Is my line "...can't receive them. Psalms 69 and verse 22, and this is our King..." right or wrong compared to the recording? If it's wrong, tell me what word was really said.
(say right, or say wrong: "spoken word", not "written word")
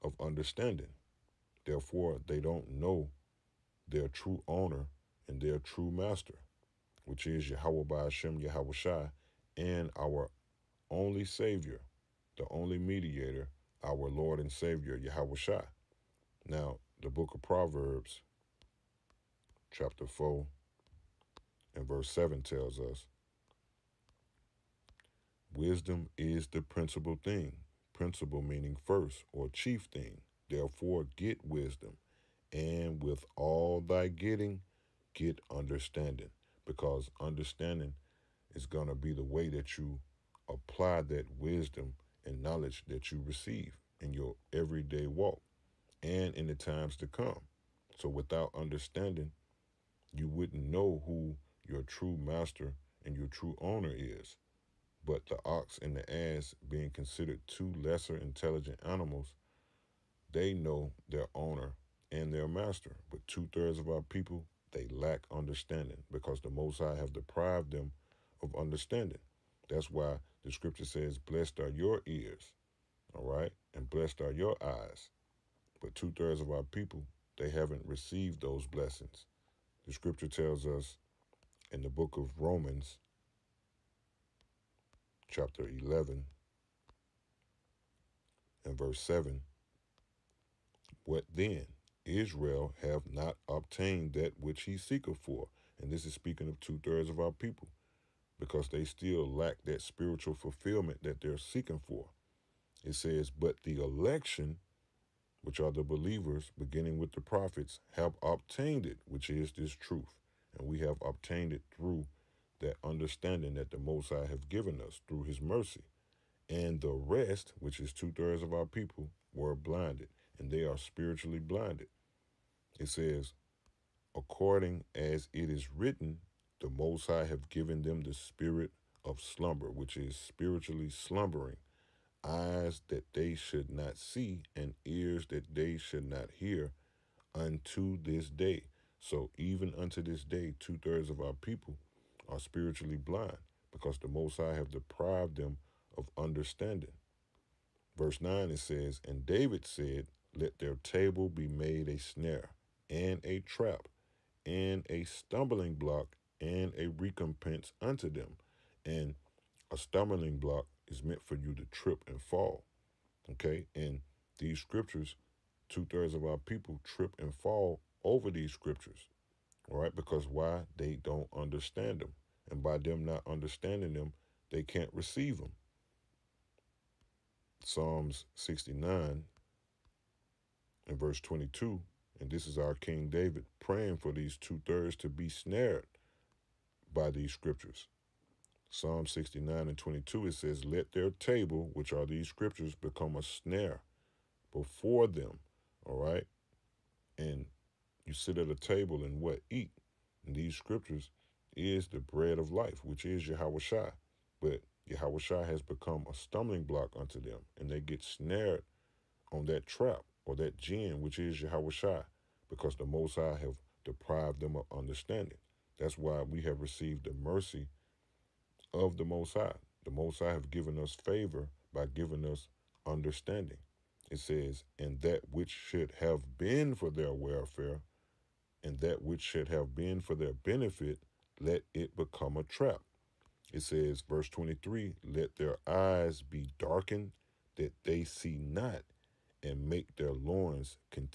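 right.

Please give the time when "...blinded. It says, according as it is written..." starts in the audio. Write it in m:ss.
2:01.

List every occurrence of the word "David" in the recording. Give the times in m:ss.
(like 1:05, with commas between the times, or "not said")
2:29, 3:03.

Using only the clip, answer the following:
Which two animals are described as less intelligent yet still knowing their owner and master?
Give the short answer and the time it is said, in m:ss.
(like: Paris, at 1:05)
The ox and the ass, at 0:55.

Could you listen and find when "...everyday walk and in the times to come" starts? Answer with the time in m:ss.
0:44.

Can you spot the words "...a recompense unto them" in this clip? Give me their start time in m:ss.
2:36.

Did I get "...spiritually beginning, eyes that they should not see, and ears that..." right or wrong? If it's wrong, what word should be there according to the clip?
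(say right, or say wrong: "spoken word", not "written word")
wrong: "slumbering", not "beginning".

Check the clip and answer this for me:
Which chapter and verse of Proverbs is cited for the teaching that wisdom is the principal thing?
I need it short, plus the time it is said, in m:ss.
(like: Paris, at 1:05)
Chapter 4, verse 7, at 0:19.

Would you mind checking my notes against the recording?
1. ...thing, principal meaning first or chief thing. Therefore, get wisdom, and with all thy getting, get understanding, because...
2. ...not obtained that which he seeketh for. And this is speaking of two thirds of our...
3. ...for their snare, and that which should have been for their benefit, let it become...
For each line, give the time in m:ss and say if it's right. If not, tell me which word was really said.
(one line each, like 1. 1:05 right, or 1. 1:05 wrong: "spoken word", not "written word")
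1. 0:27 right
2. 1:33 right
3. 3:46 wrong: "welfare", not "snare".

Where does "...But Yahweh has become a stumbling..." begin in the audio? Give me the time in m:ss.
3:24.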